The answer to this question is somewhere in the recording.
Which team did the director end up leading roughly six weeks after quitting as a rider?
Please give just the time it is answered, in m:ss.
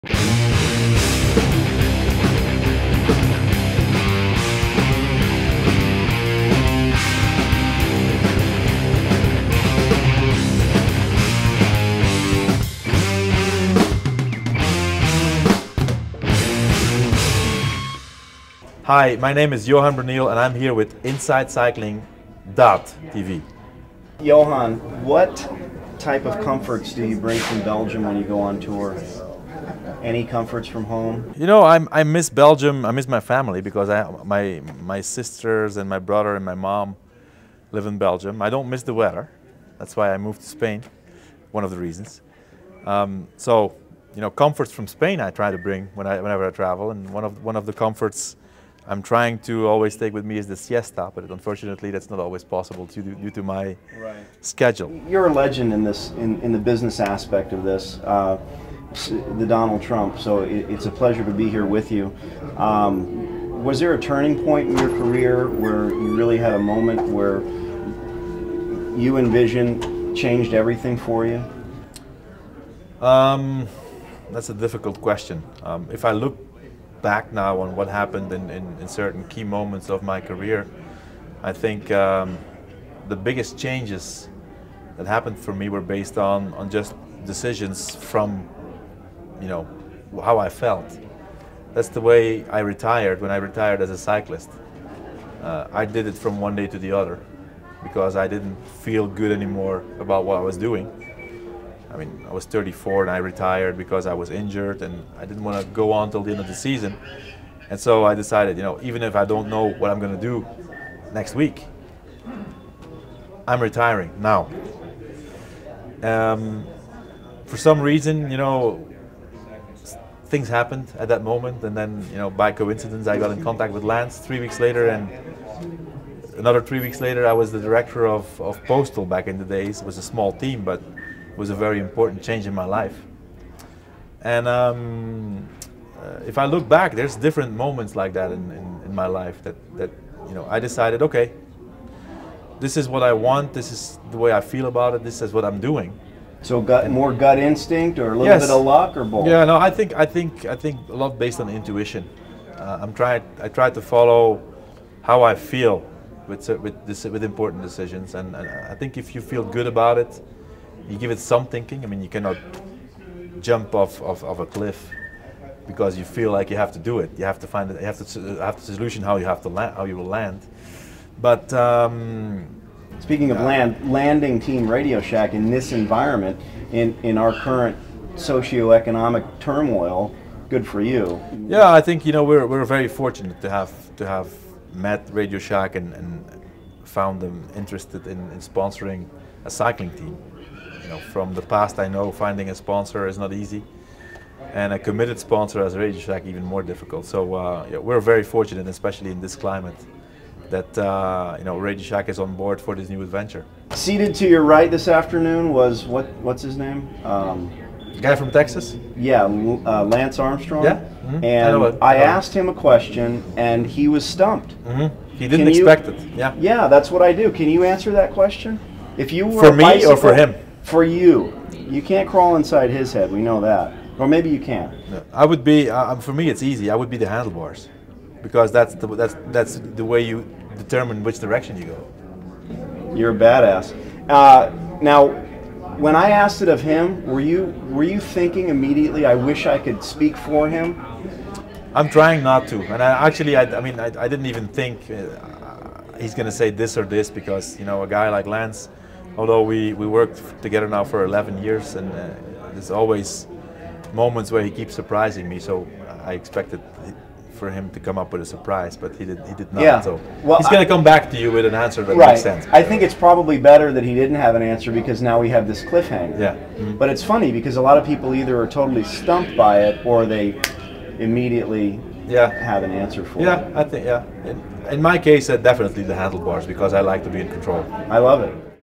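2:08.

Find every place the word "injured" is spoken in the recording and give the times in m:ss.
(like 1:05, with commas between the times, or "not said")
1:44.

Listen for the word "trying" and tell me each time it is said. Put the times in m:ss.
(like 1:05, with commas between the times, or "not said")
0:49, 2:32, 4:01.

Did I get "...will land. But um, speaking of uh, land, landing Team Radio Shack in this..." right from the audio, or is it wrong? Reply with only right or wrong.
right.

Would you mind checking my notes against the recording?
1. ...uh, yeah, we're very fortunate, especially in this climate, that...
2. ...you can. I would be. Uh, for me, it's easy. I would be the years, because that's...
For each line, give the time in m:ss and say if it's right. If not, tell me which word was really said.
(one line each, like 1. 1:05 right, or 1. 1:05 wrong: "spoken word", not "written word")
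1. 3:17 right
2. 3:44 wrong: "handlebars", not "years".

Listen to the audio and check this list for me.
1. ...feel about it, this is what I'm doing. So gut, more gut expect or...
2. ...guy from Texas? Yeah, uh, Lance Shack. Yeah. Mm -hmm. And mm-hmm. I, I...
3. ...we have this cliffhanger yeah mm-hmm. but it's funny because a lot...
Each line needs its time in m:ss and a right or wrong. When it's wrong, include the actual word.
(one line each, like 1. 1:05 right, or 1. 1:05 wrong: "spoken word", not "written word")
1. 2:24 wrong: "instinct", not "expect"
2. 3:28 wrong: "Armstrong", not "Shack"
3. 4:25 right.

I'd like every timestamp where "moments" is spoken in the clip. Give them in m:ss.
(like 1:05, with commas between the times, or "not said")
1:06, 1:19, 2:01, 2:17, 4:13.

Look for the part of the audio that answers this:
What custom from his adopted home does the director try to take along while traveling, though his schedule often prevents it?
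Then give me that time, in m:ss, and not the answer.
0:50.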